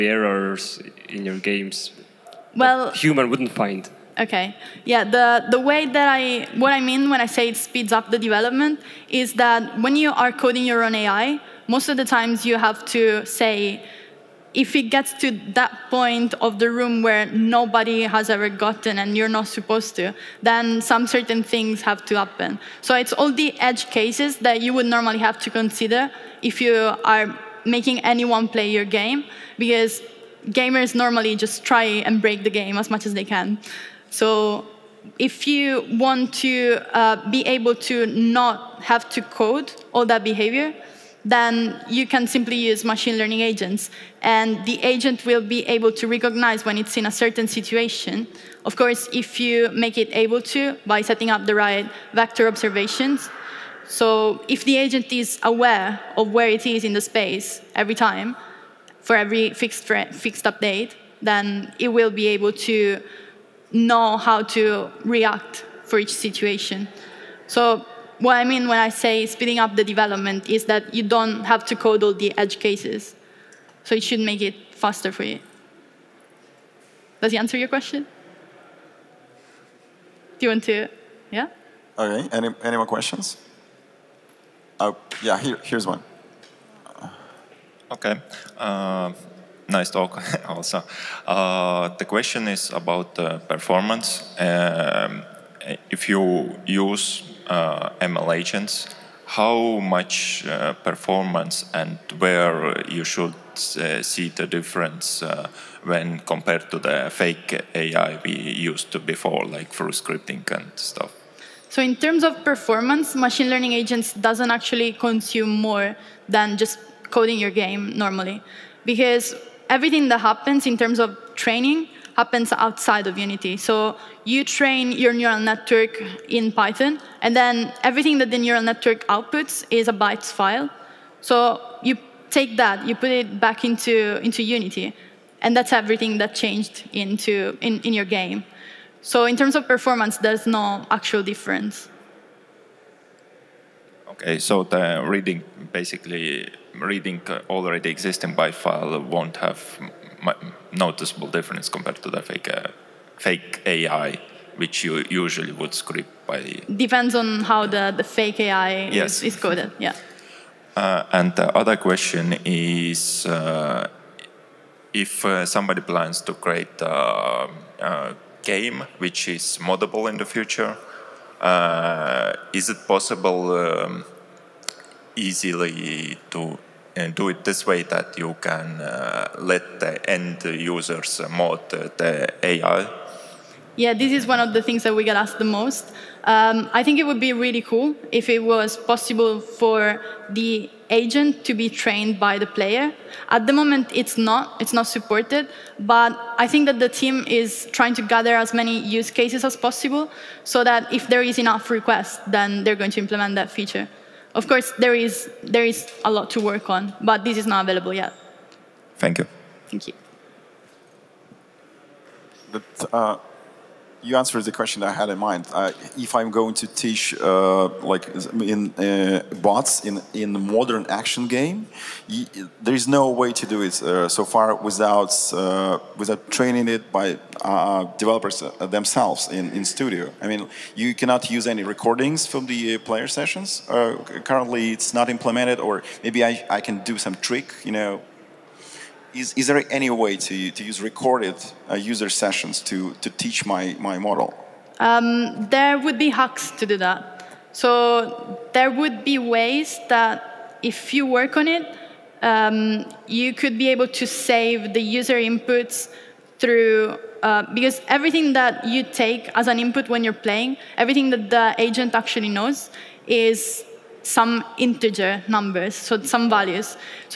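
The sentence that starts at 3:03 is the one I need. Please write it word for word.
Yeah, this is one of the things that we get asked the most.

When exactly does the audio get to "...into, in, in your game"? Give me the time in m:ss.
2:17.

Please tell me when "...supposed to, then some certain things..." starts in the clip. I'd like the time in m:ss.
0:19.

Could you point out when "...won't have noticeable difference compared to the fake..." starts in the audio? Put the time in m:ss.
2:29.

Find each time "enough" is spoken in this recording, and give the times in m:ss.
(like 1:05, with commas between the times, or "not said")
3:21.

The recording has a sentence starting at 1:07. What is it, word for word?
So what I mean when I say speeding up the development is that you don't have to code all the edge cases.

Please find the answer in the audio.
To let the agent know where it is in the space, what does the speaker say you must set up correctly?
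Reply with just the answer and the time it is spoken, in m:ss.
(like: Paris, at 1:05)
vector observations, at 0:52.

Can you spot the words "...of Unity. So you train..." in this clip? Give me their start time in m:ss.
2:03.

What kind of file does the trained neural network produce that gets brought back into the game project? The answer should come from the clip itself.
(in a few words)
bytes file.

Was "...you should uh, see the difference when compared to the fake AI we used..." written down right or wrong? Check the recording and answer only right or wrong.
right.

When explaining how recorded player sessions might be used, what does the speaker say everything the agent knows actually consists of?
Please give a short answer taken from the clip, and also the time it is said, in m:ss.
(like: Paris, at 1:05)
integer numbers, at 4:24.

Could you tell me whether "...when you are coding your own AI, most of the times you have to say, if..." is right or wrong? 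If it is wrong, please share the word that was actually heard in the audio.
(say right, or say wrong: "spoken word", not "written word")
right.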